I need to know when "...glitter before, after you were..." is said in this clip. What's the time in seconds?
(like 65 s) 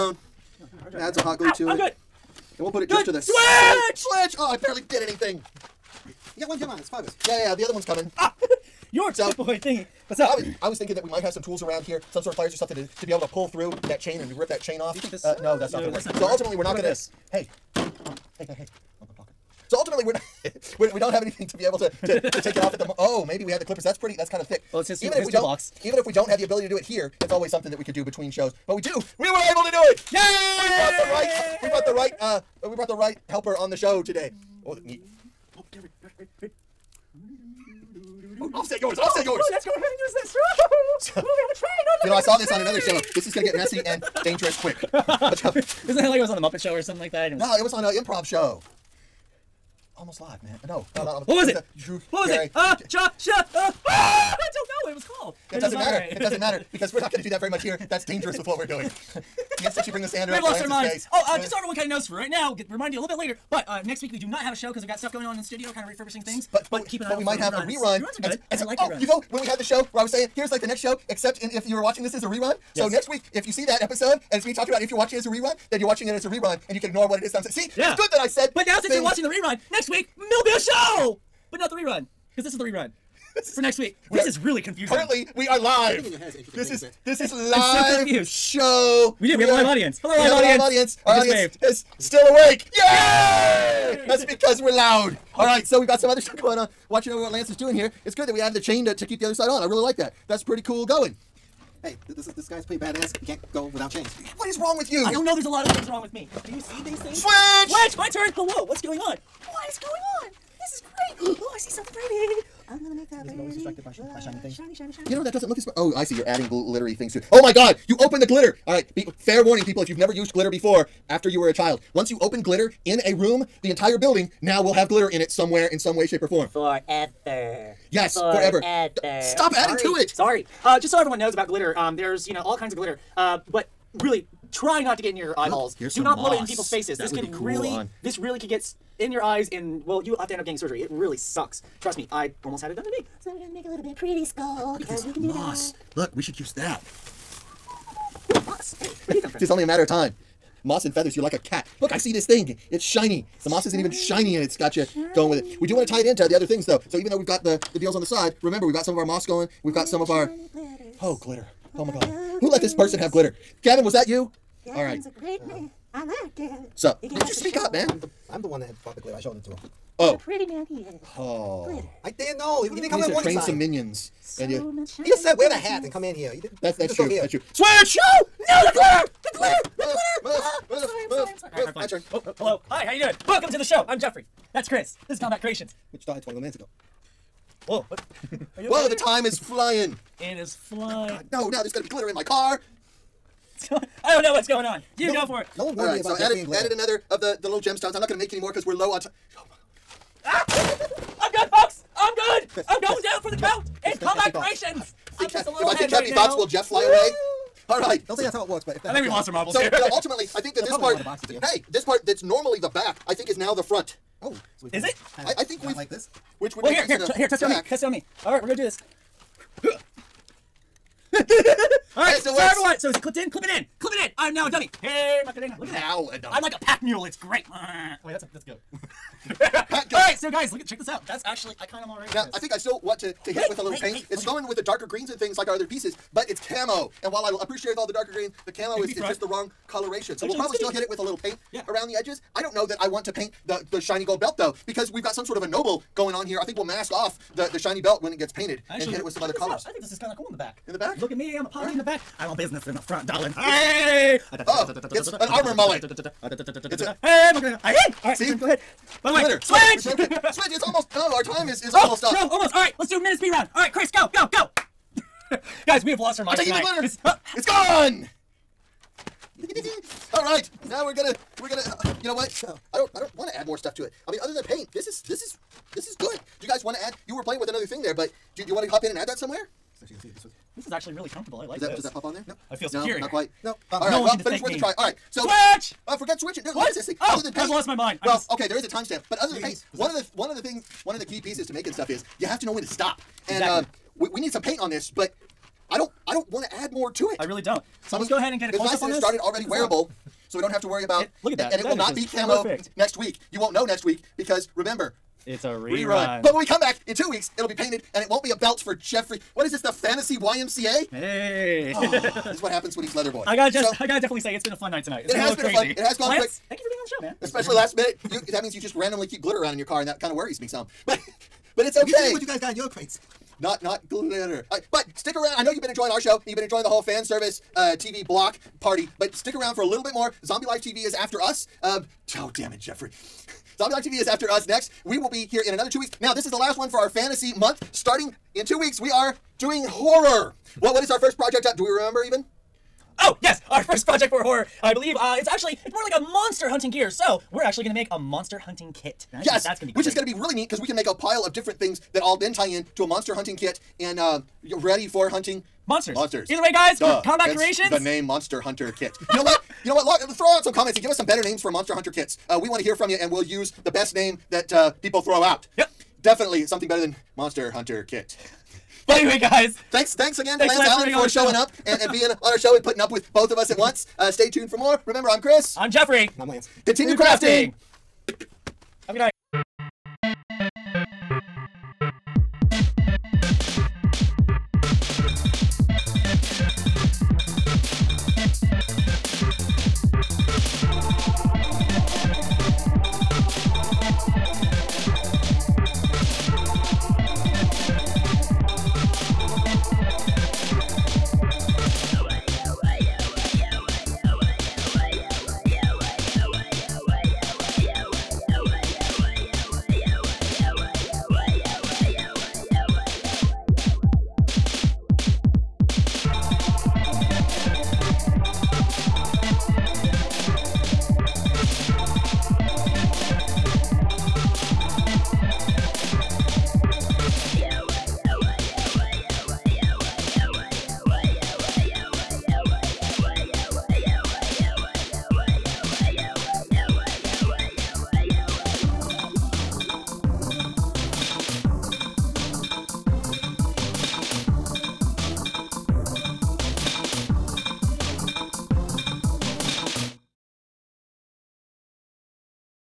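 120 s.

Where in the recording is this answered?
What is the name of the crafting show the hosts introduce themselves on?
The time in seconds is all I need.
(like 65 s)
185 s.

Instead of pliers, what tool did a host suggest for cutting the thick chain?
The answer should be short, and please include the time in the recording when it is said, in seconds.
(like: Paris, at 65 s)
Clippers, at 23 s.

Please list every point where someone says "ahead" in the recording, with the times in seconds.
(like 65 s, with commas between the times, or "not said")
39 s, 258 s, 298 s.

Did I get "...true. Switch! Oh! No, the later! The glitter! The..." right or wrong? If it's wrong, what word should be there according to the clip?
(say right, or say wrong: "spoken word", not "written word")
wrong: "glitter", not "later".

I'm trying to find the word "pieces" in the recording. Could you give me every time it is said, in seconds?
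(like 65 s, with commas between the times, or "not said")
235 s, 291 s.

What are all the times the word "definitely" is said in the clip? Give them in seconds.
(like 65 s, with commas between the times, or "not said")
314 s, 366 s.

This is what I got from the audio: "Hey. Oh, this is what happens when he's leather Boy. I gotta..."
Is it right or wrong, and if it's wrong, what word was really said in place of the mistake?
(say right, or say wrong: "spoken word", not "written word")
right.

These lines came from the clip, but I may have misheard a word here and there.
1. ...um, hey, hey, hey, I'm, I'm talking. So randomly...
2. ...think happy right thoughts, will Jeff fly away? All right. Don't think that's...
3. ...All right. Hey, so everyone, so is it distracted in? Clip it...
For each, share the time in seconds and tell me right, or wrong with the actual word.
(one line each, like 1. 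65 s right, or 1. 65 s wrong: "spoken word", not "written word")
1. 17 s wrong: "ultimately", not "randomly"
2. 205 s right
3. 221 s wrong: "clipped", not "distracted".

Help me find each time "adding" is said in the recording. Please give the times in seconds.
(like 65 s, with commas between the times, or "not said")
116 s, 129 s.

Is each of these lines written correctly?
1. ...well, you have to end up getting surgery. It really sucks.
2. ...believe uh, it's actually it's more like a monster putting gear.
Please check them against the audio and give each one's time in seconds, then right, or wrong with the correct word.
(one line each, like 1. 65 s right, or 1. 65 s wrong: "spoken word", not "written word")
1. 139 s right
2. 344 s wrong: "hunting", not "putting".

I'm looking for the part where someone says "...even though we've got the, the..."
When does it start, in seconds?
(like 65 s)
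156 s.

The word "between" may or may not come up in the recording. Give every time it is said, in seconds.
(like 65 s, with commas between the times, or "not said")
28 s.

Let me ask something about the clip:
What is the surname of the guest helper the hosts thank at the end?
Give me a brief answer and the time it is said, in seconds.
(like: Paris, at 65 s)
Allen, at 370 s.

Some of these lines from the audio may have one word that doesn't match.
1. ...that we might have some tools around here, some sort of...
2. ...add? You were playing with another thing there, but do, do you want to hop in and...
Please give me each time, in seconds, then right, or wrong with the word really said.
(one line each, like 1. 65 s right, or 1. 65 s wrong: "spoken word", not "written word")
1. 10 s right
2. 276 s right.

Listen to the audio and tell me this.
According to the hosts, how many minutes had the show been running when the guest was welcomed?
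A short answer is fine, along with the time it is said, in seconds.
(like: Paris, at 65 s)
21, at 186 s.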